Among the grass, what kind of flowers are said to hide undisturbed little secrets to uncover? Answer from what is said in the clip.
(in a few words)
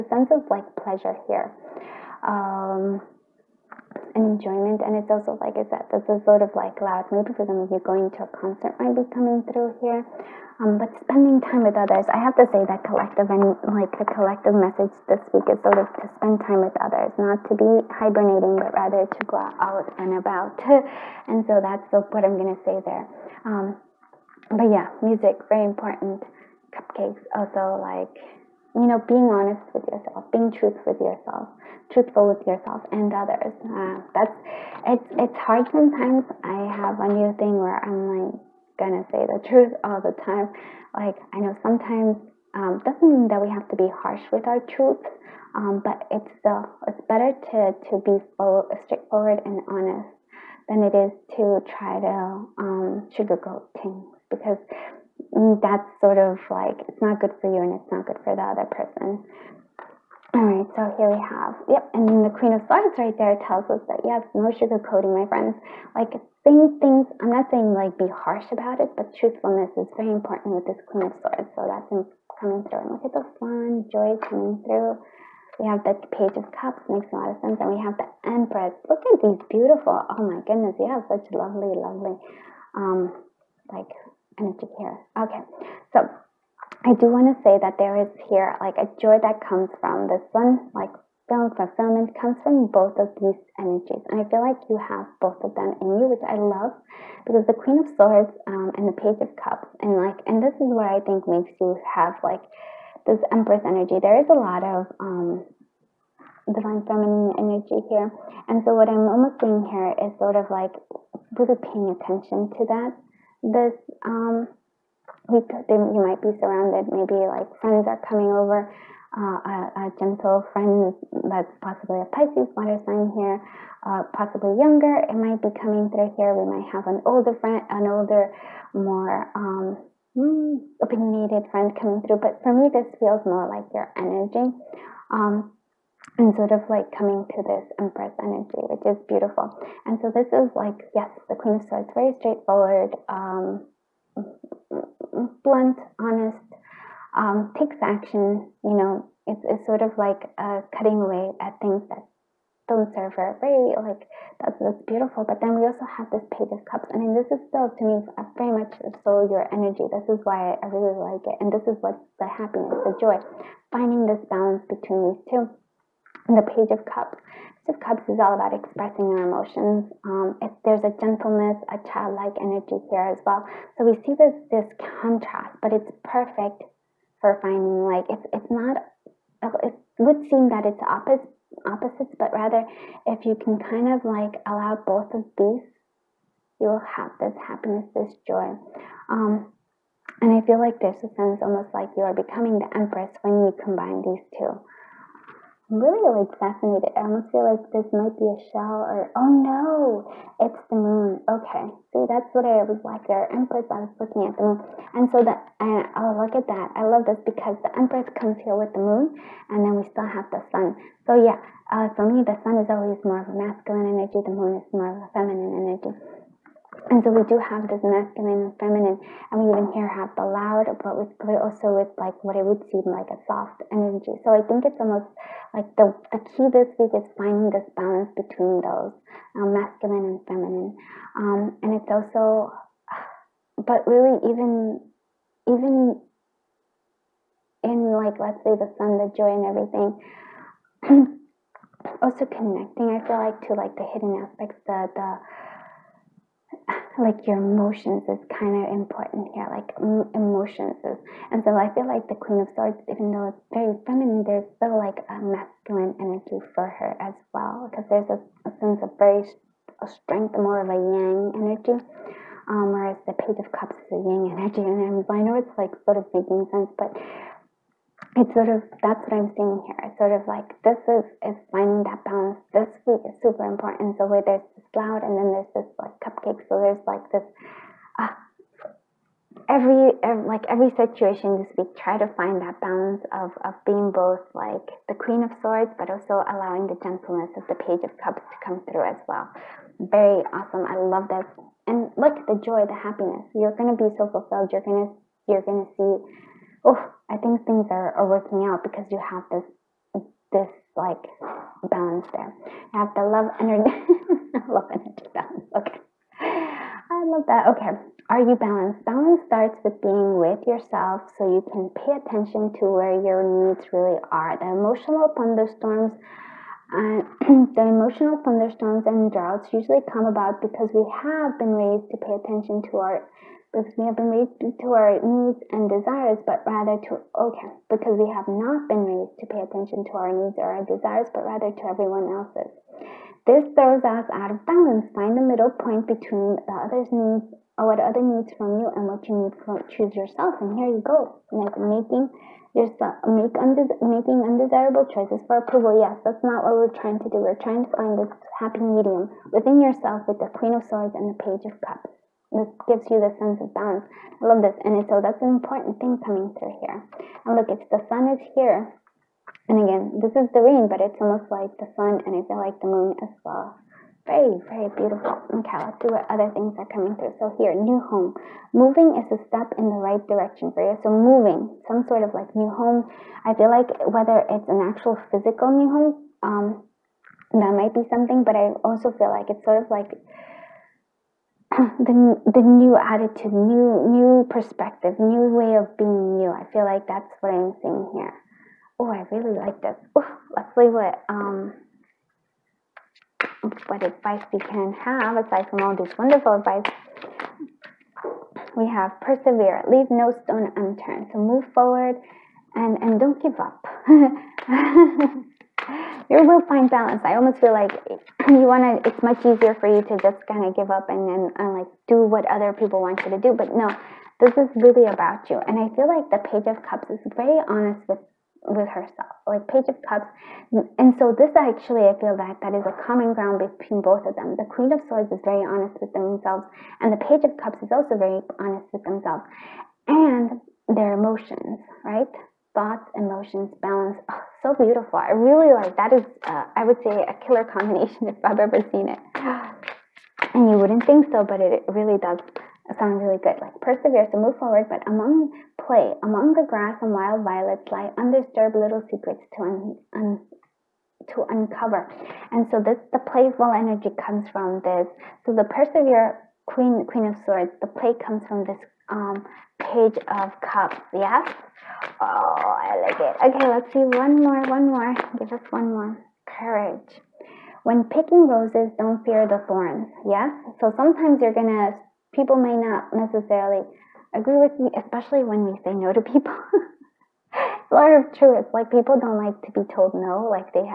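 Wild violets.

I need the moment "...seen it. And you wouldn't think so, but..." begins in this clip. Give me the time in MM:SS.
07:18.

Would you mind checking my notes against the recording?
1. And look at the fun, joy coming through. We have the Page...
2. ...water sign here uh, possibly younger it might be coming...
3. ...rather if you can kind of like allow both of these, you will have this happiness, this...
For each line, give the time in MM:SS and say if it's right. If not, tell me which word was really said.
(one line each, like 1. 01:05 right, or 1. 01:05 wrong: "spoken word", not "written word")
1. 01:12 right
2. 02:02 right
3. 03:02 right.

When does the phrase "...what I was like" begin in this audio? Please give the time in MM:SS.
03:22.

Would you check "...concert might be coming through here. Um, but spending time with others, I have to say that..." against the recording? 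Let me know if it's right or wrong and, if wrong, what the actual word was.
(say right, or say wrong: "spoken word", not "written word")
right.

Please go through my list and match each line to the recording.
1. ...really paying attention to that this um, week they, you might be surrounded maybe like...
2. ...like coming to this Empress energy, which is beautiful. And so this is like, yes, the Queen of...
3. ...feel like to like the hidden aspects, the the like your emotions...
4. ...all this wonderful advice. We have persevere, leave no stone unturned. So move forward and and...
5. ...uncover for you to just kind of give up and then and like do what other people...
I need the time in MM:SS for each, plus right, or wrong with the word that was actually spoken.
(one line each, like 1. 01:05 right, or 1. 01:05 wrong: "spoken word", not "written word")
1. 01:51 right
2. 02:16 right
3. 04:03 right
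4. 06:35 right
5. 06:49 wrong: "easier", not "uncover".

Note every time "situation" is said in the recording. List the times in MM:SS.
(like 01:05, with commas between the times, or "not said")
04:40.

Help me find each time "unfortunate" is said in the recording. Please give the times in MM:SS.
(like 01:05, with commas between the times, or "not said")
not said.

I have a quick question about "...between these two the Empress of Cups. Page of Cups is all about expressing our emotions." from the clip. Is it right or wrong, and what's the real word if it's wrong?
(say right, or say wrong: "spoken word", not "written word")
wrong: "Page", not "Empress".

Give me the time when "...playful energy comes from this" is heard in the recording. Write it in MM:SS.
07:33.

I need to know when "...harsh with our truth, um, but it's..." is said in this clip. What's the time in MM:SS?
00:43.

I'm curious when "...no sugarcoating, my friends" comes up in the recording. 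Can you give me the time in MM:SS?
01:04.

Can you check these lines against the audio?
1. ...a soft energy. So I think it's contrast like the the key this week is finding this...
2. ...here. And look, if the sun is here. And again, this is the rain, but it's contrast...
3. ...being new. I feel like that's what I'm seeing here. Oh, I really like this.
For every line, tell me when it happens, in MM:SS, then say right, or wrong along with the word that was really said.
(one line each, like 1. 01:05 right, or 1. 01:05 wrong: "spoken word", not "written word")
1. 03:43 wrong: "almost", not "contrast"
2. 05:56 wrong: "almost", not "contrast"
3. 06:25 right.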